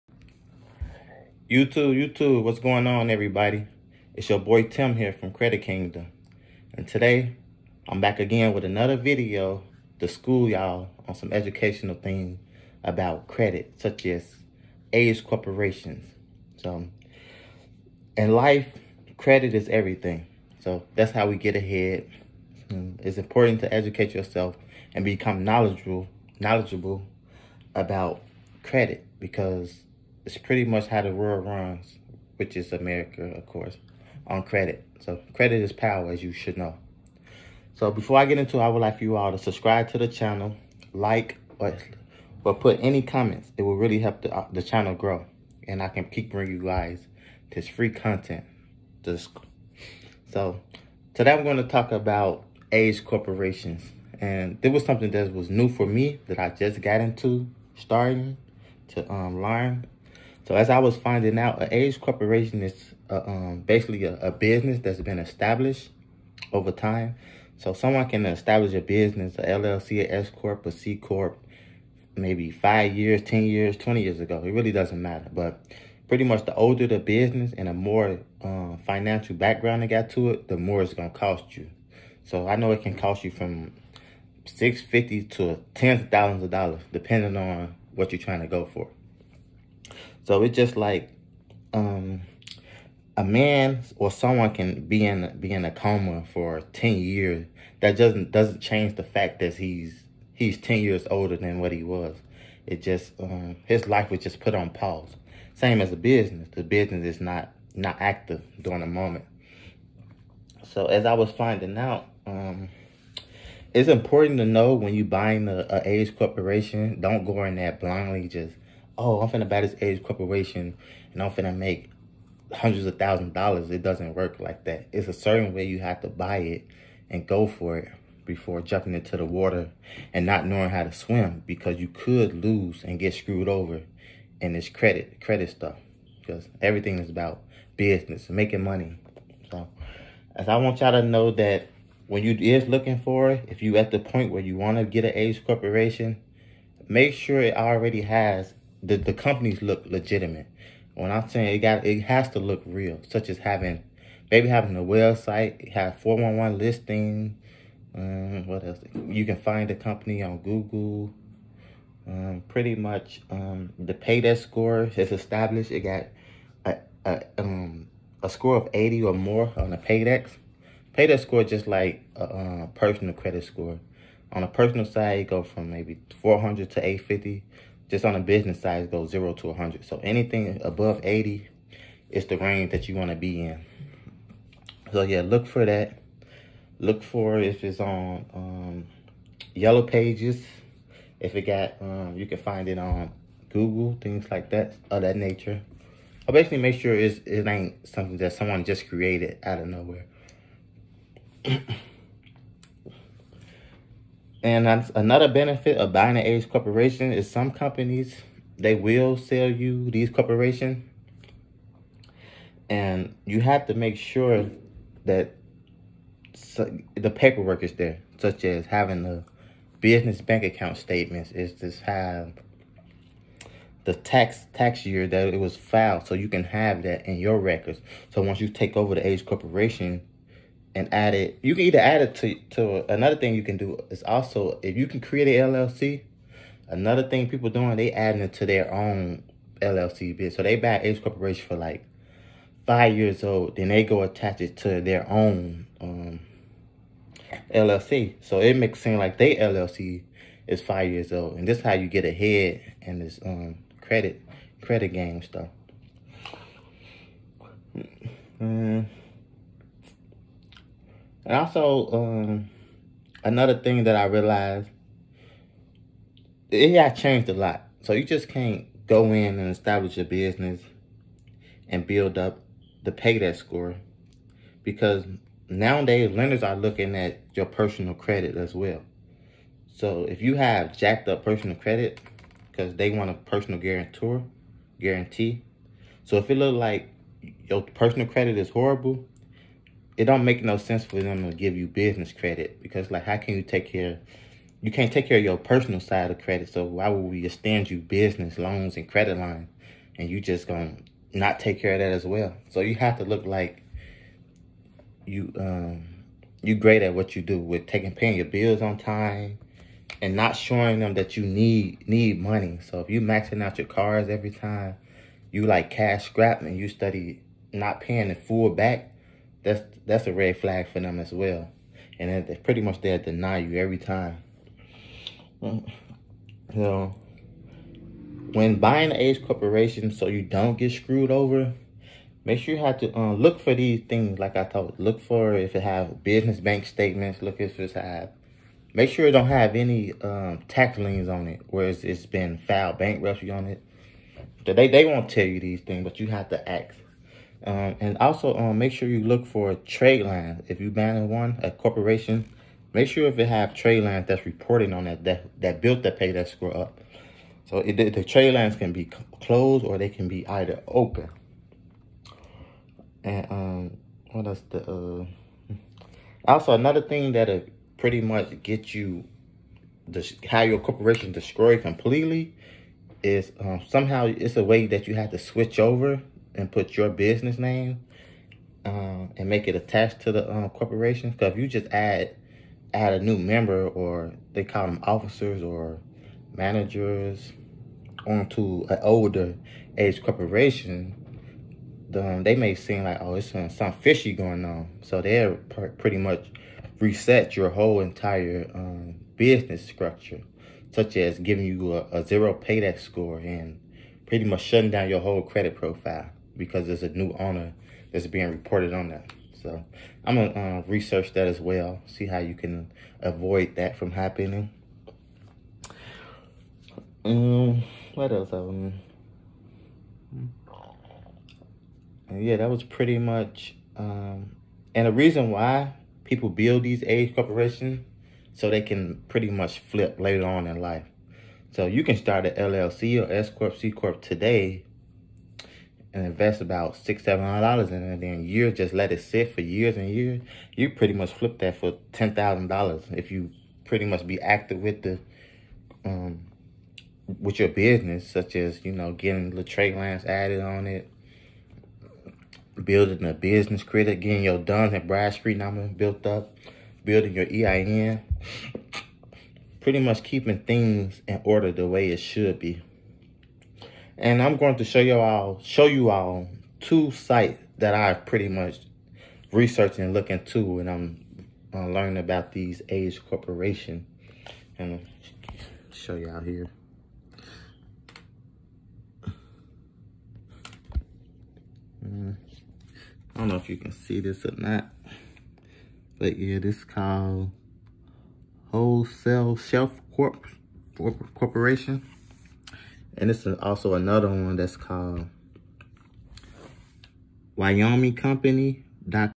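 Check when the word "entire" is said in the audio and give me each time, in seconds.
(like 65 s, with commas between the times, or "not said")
397 s.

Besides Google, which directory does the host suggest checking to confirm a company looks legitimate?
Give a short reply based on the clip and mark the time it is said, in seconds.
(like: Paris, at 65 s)
Yellow Pages, at 189 s.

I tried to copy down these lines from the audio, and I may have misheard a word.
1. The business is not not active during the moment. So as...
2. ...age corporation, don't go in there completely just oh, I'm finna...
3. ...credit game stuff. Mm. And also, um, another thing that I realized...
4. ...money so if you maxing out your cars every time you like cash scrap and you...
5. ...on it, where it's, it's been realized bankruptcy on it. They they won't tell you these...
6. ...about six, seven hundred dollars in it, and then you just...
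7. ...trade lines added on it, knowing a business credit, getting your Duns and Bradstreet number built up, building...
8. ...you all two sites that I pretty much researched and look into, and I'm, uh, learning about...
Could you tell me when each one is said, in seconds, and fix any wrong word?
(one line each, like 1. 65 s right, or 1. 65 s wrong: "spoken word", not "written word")
1. 106 s right
2. 115 s wrong: "blindly", not "completely"
3. 254 s right
4. 312 s right
5. 341 s wrong: "filed", not "realized"
6. 436 s right
7. 449 s wrong: "building", not "knowing"
8. 465 s right.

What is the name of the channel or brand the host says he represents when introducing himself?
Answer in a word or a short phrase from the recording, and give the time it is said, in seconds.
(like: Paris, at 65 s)
Credit Kingdom, at 5 s.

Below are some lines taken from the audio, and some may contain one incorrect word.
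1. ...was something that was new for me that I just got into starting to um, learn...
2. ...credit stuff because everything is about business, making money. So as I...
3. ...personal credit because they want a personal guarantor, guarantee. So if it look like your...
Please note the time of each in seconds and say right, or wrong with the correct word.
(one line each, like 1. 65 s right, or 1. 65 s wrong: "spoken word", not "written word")
1. 54 s right
2. 135 s right
3. 281 s right.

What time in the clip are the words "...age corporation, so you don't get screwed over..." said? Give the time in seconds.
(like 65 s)
328 s.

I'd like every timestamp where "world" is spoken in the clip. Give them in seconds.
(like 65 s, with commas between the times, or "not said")
31 s.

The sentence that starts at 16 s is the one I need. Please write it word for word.
So, in life, credit is everything.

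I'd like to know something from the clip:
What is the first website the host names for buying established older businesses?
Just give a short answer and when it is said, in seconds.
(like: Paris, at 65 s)
Wholesale Shelf Corp, at 488 s.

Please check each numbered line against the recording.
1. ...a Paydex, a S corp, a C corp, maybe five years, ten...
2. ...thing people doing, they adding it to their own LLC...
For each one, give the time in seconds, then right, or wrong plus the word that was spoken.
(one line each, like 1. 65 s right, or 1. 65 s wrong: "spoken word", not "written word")
1. 69 s wrong: "LLC", not "Paydex"
2. 237 s right.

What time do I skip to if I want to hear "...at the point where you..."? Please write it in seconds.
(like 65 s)
143 s.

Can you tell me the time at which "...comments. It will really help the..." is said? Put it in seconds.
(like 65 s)
43 s.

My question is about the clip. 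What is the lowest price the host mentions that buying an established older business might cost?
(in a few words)
$650.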